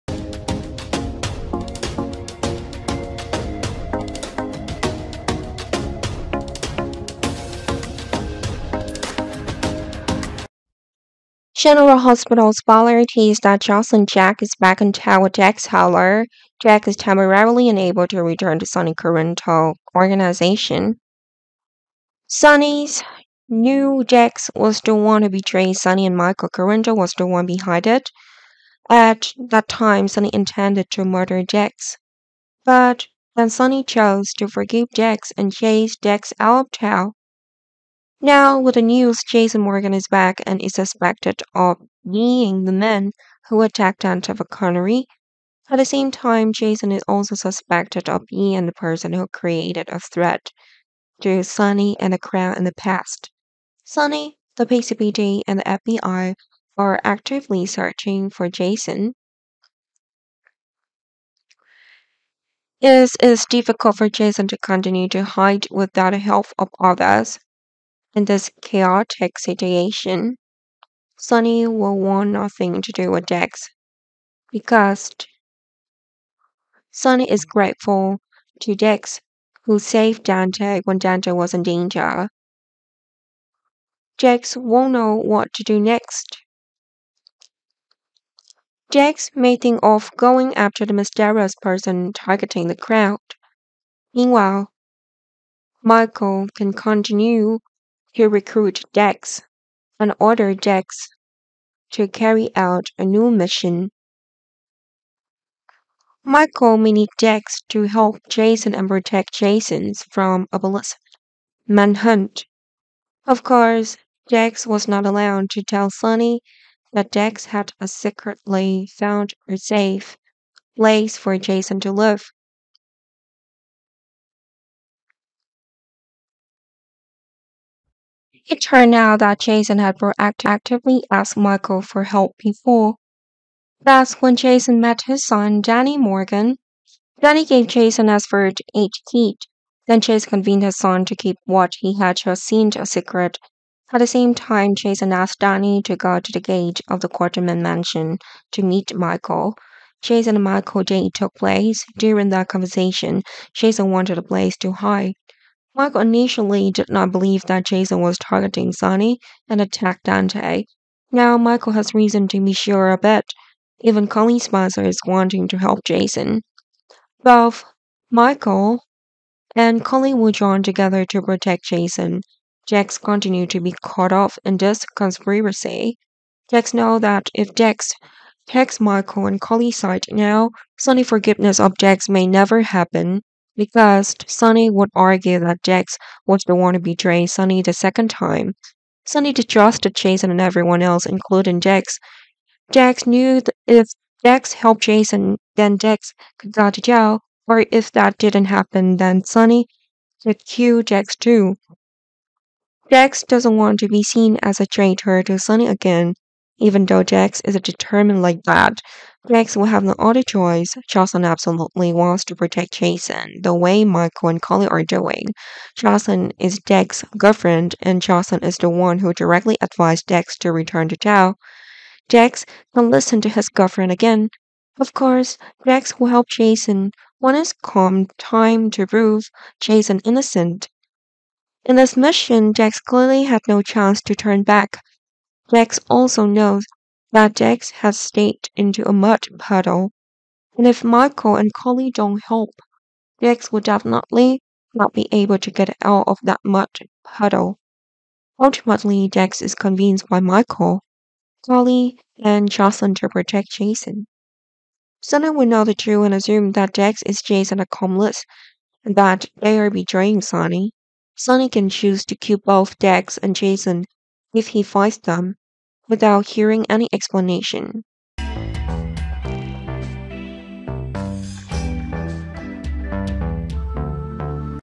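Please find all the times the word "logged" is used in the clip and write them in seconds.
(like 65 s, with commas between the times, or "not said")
not said.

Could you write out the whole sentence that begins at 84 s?
Dex won't know what to do next.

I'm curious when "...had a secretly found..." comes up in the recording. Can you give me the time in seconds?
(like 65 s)
117 s.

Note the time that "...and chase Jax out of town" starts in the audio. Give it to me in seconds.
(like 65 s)
35 s.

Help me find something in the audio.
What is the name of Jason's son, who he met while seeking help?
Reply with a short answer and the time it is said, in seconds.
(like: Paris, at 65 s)
Danny Morgan, at 135 s.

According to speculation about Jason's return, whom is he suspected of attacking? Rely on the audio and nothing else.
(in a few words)
Antiva Connery.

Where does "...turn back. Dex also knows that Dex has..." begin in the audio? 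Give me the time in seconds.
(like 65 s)
234 s.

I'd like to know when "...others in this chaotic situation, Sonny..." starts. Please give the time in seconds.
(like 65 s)
66 s.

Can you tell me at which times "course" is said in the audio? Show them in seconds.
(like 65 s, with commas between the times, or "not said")
113 s, 224 s.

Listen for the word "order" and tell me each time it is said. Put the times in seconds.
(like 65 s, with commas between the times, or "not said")
100 s.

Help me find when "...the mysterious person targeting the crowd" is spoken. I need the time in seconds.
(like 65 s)
90 s.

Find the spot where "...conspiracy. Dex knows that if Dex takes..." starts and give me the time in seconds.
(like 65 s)
174 s.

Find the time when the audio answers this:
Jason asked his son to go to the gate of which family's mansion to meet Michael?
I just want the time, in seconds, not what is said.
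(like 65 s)
147 s.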